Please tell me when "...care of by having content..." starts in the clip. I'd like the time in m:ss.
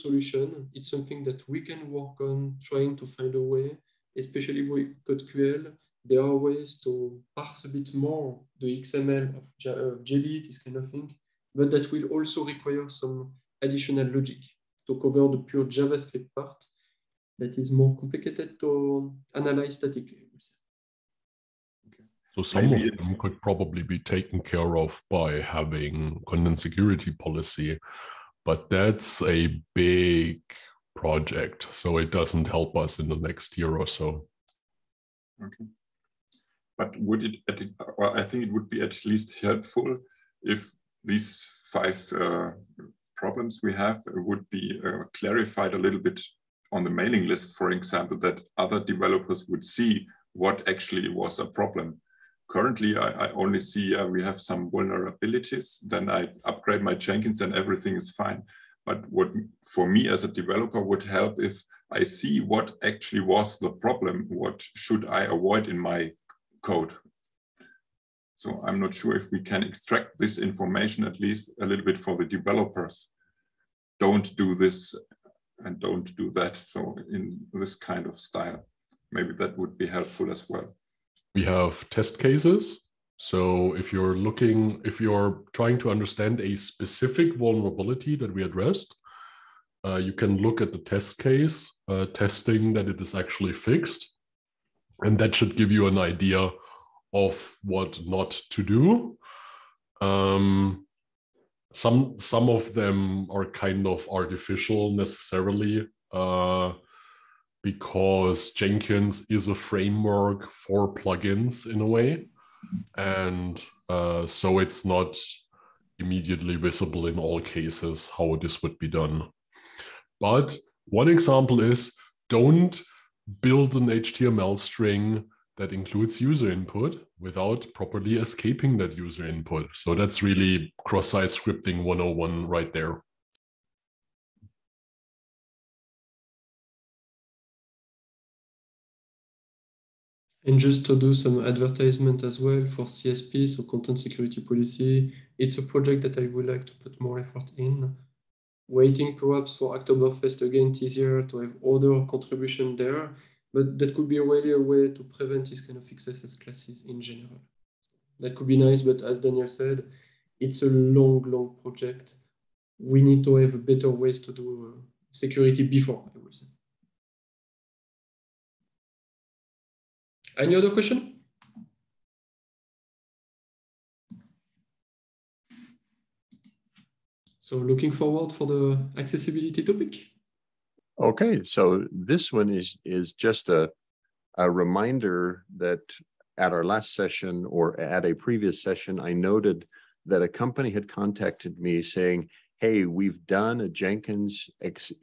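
0:24.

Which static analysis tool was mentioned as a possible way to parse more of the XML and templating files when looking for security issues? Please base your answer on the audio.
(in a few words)
CodeQL.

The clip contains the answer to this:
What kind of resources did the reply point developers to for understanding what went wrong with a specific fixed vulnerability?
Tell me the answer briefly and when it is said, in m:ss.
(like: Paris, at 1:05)
Test cases, at 1:21.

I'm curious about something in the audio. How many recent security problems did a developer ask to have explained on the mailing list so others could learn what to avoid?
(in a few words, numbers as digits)
5.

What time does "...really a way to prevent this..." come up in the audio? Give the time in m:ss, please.
2:34.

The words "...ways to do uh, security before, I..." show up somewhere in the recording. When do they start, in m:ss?
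2:43.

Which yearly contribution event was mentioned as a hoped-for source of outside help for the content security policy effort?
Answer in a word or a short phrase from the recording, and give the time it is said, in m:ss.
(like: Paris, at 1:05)
Oktoberfest, at 2:29.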